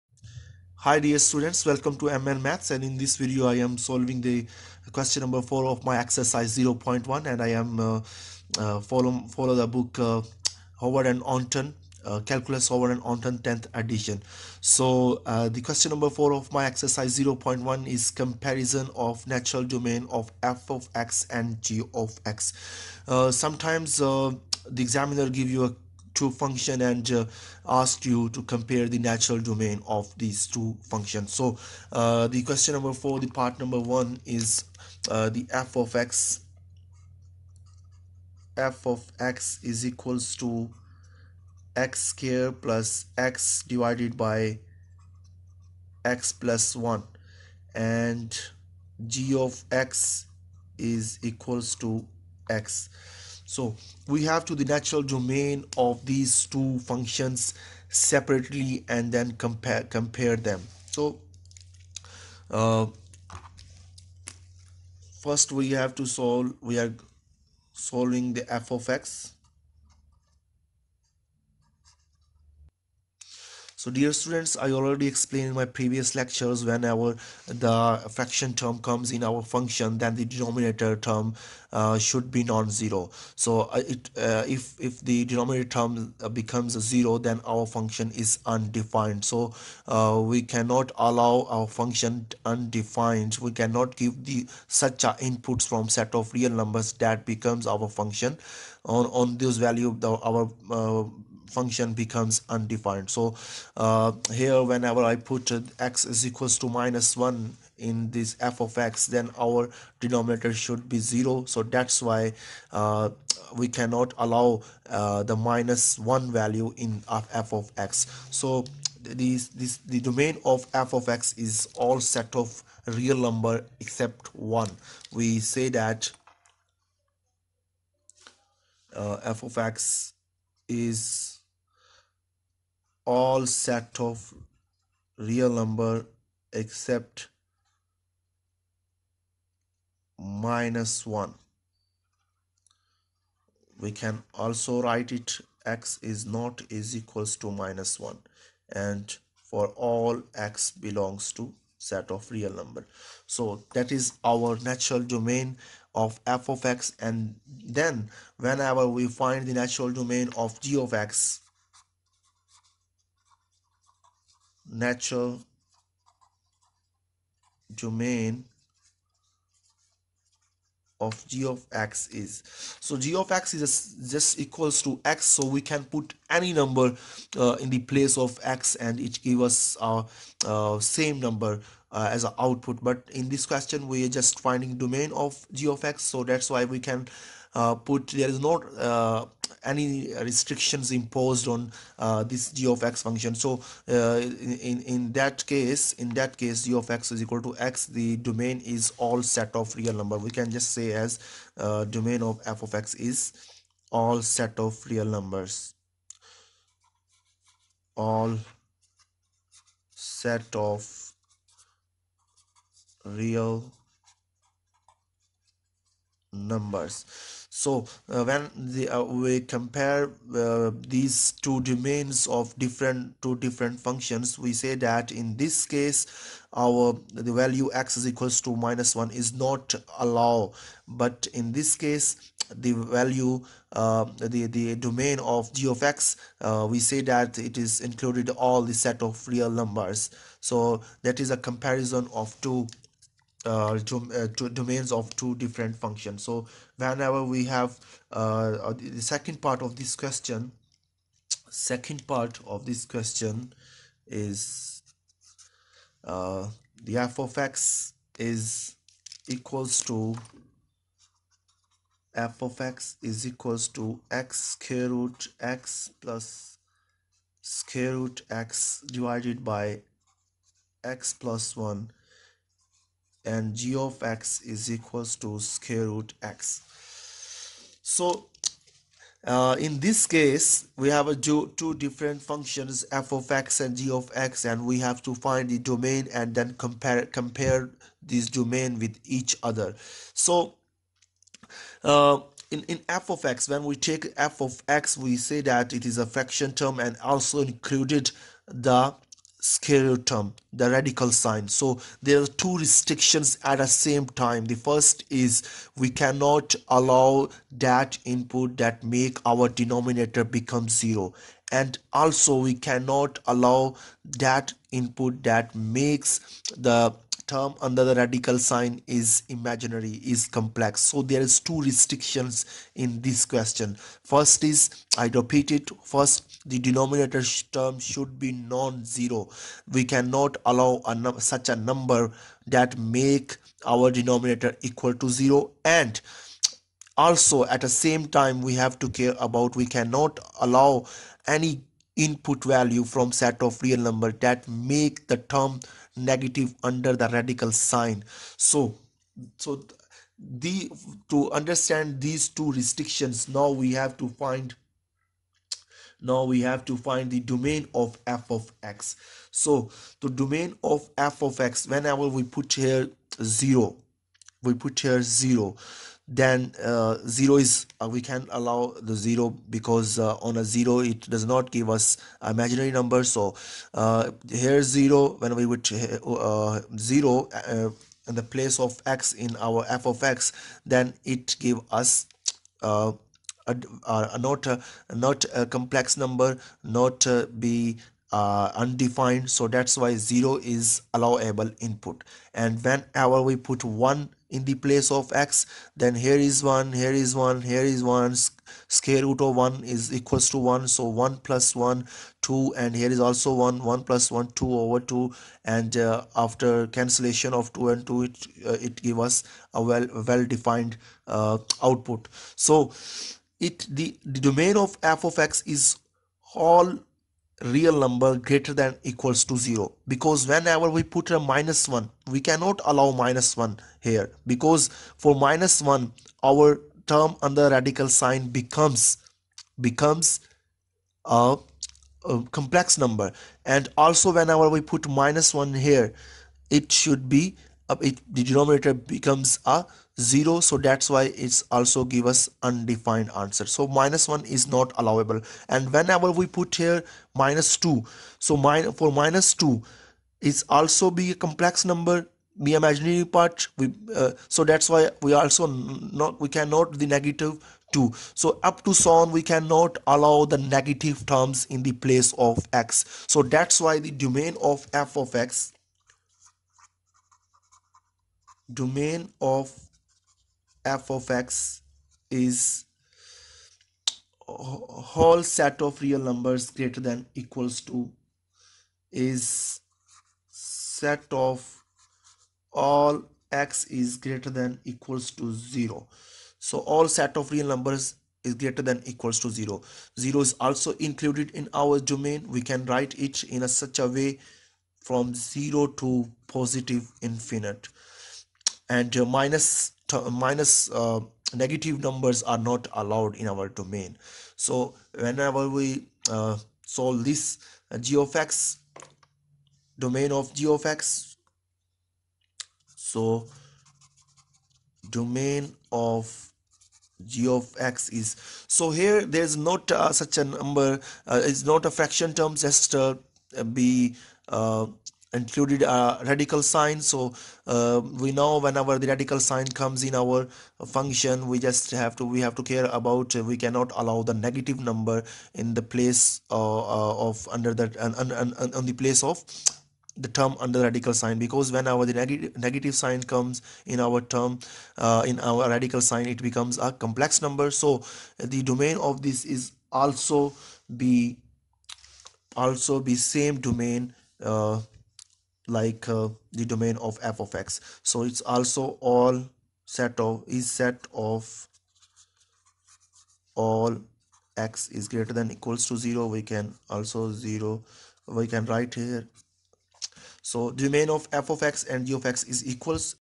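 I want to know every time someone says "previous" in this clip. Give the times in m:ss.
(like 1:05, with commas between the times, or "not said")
1:15.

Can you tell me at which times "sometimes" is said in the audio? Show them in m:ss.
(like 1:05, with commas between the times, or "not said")
0:23.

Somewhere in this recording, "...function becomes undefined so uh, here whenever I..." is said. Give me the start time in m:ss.
1:41.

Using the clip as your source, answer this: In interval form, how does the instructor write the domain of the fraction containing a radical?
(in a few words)
0 to positive infinity.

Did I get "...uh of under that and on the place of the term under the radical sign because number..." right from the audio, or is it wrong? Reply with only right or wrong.
wrong.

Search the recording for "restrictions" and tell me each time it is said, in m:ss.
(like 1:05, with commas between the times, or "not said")
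3:10, 5:02, 5:21, 5:52.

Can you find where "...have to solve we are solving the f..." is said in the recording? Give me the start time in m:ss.
1:05.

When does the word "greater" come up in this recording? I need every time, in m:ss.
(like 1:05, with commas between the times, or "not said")
6:58, 7:56, 8:03, 8:08, 9:24.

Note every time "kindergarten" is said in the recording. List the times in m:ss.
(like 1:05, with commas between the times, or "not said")
not said.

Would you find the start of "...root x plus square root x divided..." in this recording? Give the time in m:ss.
4:24.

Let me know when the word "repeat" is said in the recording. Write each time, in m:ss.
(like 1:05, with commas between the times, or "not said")
5:25.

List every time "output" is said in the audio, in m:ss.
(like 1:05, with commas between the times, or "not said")
3:02, 6:51.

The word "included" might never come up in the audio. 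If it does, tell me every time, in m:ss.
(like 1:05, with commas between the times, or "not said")
3:57, 4:57, 8:10, 8:45.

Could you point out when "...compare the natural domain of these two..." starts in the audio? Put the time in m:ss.
0:28.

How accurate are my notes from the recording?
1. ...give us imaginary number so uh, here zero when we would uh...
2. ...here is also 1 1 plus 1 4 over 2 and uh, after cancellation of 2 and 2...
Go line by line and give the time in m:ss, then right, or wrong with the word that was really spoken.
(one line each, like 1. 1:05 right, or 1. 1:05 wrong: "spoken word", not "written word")
1. 6:11 right
2. 6:42 wrong: "2", not "4".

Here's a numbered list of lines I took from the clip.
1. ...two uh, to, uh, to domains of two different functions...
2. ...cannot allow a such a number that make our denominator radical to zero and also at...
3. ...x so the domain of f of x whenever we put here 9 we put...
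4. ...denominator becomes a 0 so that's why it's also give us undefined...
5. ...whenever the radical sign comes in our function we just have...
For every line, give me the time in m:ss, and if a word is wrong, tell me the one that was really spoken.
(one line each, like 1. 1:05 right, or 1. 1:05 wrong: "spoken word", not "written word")
1. 4:02 right
2. 5:29 wrong: "equal", not "radical"
3. 5:58 wrong: "0", not "9"
4. 7:18 right
5. 8:48 right.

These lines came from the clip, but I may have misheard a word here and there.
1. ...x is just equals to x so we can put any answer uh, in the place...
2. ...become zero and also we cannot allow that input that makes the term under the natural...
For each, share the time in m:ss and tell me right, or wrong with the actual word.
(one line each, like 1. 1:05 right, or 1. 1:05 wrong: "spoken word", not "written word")
1. 2:53 wrong: "number", not "answer"
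2. 5:10 wrong: "radical", not "natural".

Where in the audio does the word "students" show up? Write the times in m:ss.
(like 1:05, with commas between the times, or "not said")
0:01, 1:14.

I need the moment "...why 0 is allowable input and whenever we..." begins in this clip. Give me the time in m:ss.
6:29.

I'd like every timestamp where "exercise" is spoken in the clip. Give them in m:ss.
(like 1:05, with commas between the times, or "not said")
0:05, 0:16.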